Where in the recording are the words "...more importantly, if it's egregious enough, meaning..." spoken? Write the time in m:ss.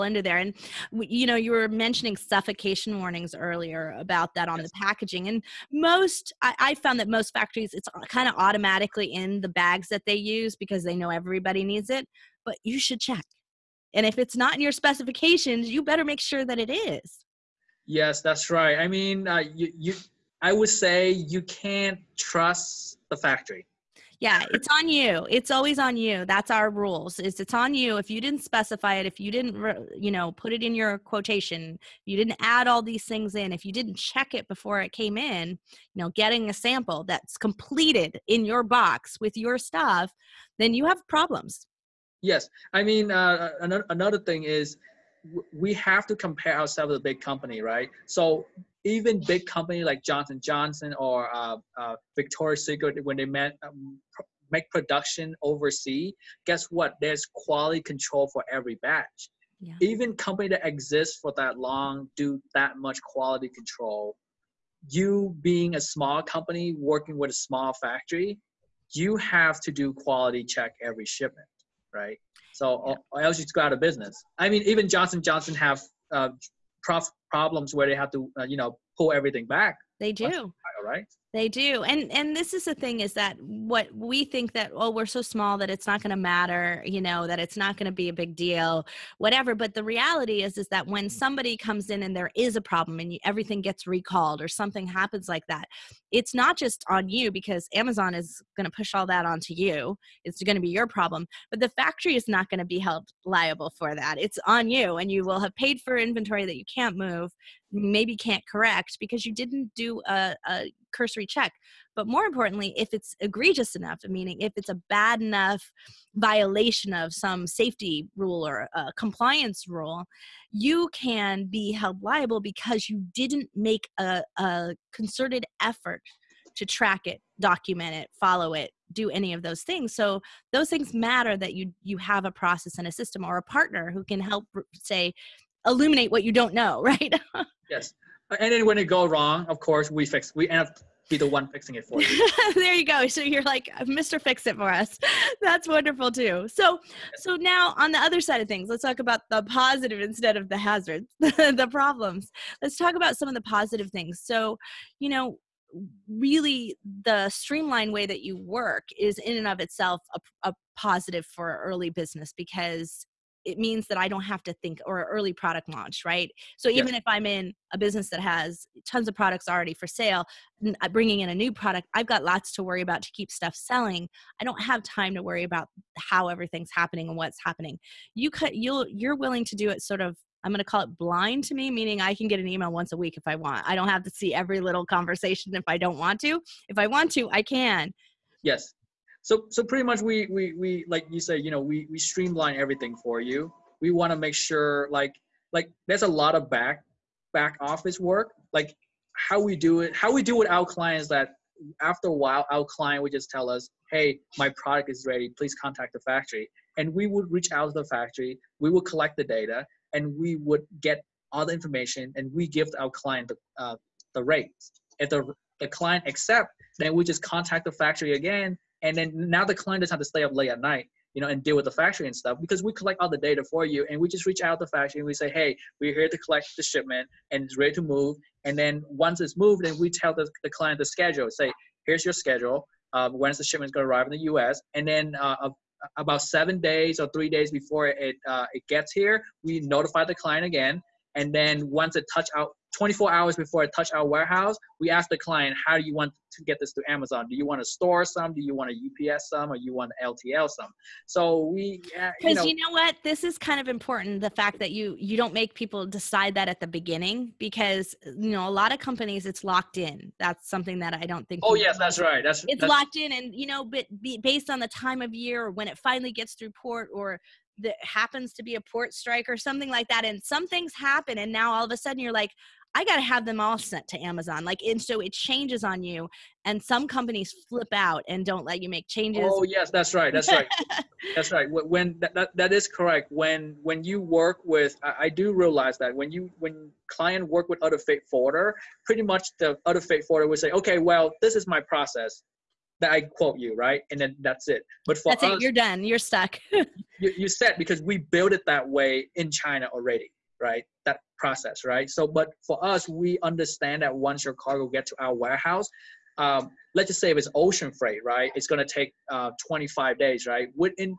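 1:52.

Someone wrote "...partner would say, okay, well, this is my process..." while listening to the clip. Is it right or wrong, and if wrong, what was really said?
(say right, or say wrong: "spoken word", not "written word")
wrong: "forwarder", not "partner".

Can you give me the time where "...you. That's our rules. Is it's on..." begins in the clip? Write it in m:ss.
0:25.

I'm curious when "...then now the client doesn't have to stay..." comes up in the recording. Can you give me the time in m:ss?
3:38.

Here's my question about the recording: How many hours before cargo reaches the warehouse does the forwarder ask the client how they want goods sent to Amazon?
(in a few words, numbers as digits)
24 hours.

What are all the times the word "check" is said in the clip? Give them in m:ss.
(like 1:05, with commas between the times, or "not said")
0:13, 0:33, 1:10, 1:51.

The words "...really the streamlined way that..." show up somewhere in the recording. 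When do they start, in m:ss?
2:36.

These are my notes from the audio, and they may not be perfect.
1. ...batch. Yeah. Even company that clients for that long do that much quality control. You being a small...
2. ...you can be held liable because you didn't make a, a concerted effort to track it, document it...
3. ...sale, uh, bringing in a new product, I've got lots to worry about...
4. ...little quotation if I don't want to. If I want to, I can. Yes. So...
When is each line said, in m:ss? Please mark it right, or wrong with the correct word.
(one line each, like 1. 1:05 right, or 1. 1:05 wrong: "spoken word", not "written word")
1. 0:58 wrong: "exists", not "clients"
2. 2:00 right
3. 2:49 right
4. 3:04 wrong: "conversation", not "quotation".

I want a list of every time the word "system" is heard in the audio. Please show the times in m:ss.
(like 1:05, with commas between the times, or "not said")
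2:12.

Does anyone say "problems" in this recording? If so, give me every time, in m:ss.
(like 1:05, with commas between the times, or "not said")
0:41, 1:17, 1:32, 1:40, 2:31.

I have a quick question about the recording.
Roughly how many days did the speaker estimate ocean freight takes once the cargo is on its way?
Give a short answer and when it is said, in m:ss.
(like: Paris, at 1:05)
25 days, at 5:09.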